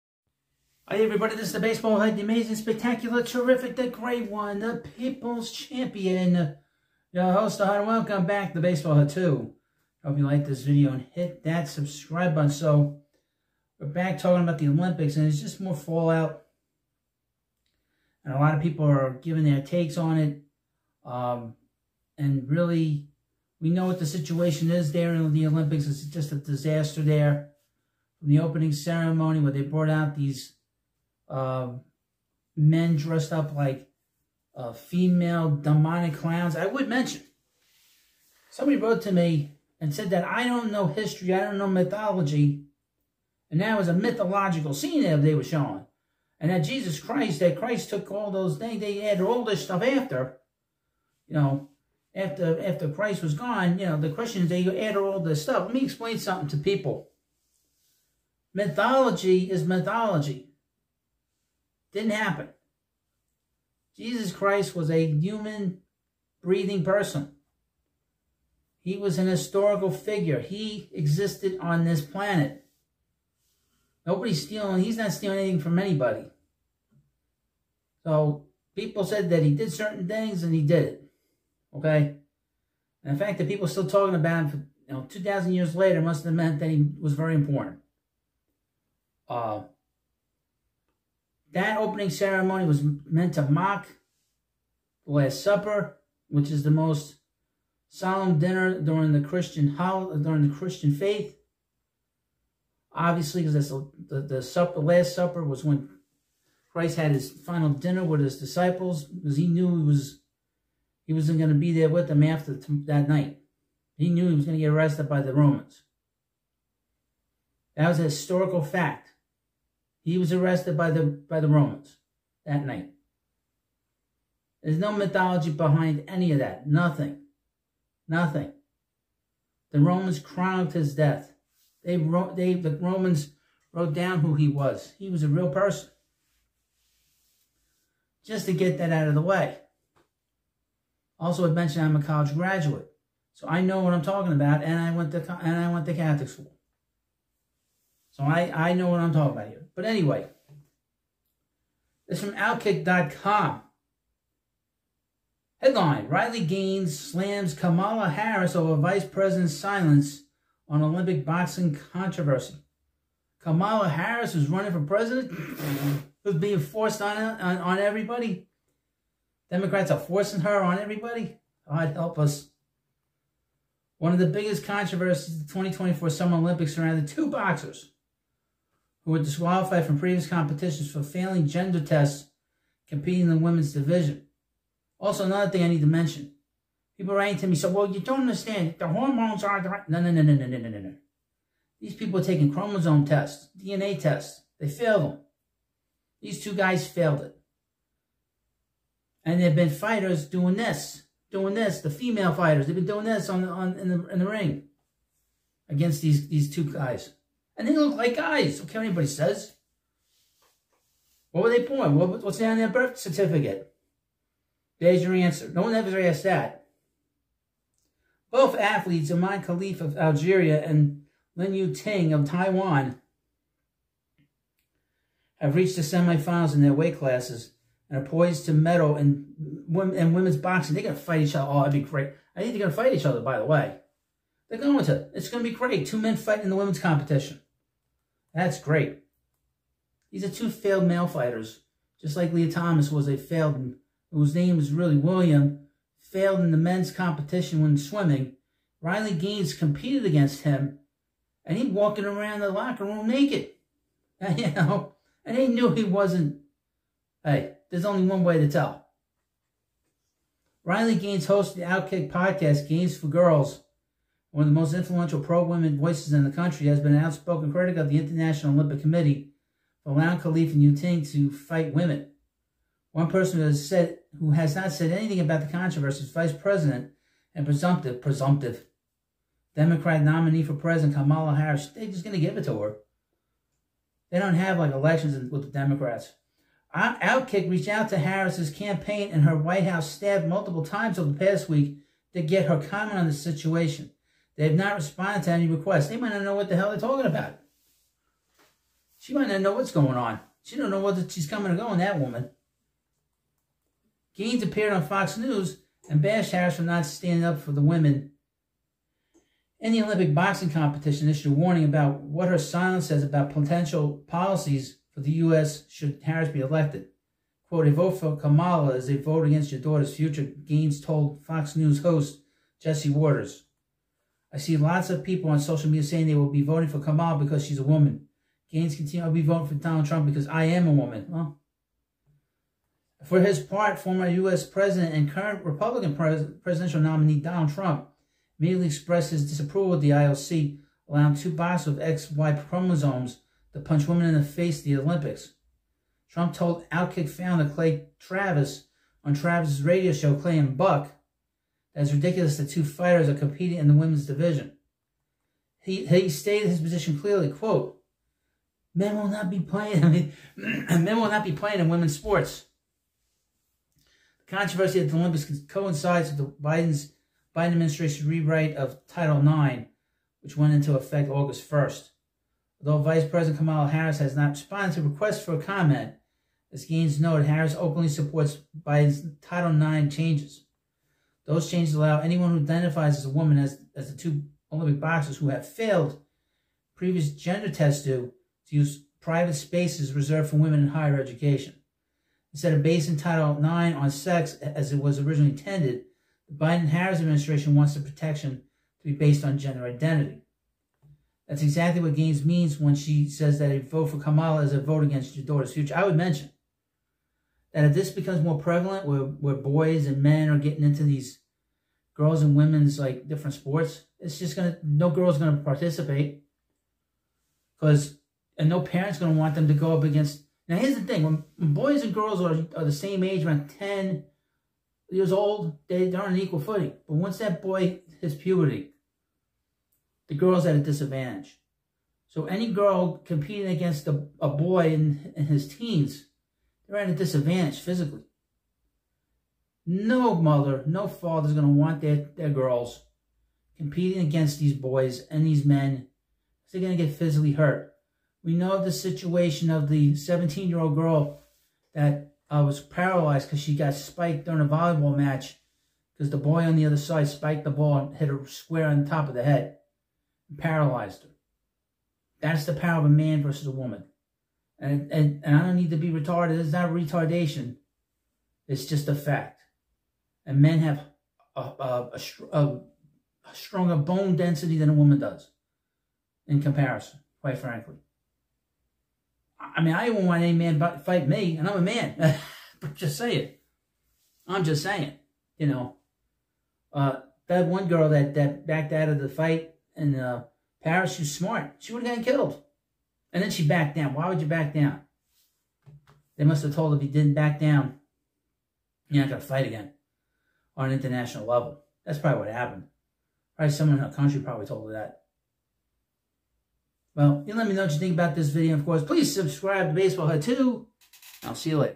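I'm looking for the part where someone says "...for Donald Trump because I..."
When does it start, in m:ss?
5:29.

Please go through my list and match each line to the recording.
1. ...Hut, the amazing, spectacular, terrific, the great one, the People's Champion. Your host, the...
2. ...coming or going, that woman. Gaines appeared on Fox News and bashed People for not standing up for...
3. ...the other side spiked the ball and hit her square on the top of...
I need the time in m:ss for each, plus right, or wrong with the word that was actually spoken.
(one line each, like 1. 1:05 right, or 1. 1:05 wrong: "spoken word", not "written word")
1. 0:01 right
2. 5:01 wrong: "Harris", not "People"
3. 7:36 right.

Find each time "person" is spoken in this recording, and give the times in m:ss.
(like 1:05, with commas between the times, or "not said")
1:06, 2:15, 4:33.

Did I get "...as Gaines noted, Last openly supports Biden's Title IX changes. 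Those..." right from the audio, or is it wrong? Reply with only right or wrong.
wrong.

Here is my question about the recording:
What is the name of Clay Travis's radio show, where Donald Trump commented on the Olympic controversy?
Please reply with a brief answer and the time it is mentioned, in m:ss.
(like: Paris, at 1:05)
Clay and Buck, at 5:50.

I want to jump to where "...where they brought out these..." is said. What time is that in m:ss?
0:29.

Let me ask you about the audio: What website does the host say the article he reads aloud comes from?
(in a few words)
Outkick.com.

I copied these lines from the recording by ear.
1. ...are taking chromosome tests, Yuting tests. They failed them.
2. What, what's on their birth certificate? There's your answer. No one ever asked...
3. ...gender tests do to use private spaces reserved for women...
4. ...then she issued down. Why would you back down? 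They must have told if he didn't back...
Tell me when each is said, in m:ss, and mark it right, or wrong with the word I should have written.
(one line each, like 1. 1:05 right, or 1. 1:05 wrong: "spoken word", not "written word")
1. 3:12 wrong: "DNA", not "Yuting"
2. 3:31 right
3. 6:27 right
4. 8:13 wrong: "backed", not "issued".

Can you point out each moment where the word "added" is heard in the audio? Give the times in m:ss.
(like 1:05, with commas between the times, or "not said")
0:49, 0:54.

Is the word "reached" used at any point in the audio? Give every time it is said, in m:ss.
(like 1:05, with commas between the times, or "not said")
3:45, 4:47.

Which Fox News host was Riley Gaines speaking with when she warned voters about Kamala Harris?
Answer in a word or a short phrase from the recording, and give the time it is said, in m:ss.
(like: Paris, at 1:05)
Jesse Watters, at 5:22.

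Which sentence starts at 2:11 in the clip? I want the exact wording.
They wrote, they, the Romans wrote down who he was.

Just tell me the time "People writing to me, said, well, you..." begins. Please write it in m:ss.
3:06.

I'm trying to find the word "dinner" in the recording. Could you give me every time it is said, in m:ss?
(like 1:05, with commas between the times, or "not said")
1:38, 1:47.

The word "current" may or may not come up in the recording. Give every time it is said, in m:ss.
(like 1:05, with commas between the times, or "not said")
5:35.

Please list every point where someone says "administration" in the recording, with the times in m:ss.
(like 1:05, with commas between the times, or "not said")
6:07, 6:36.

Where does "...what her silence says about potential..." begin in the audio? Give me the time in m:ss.
5:12.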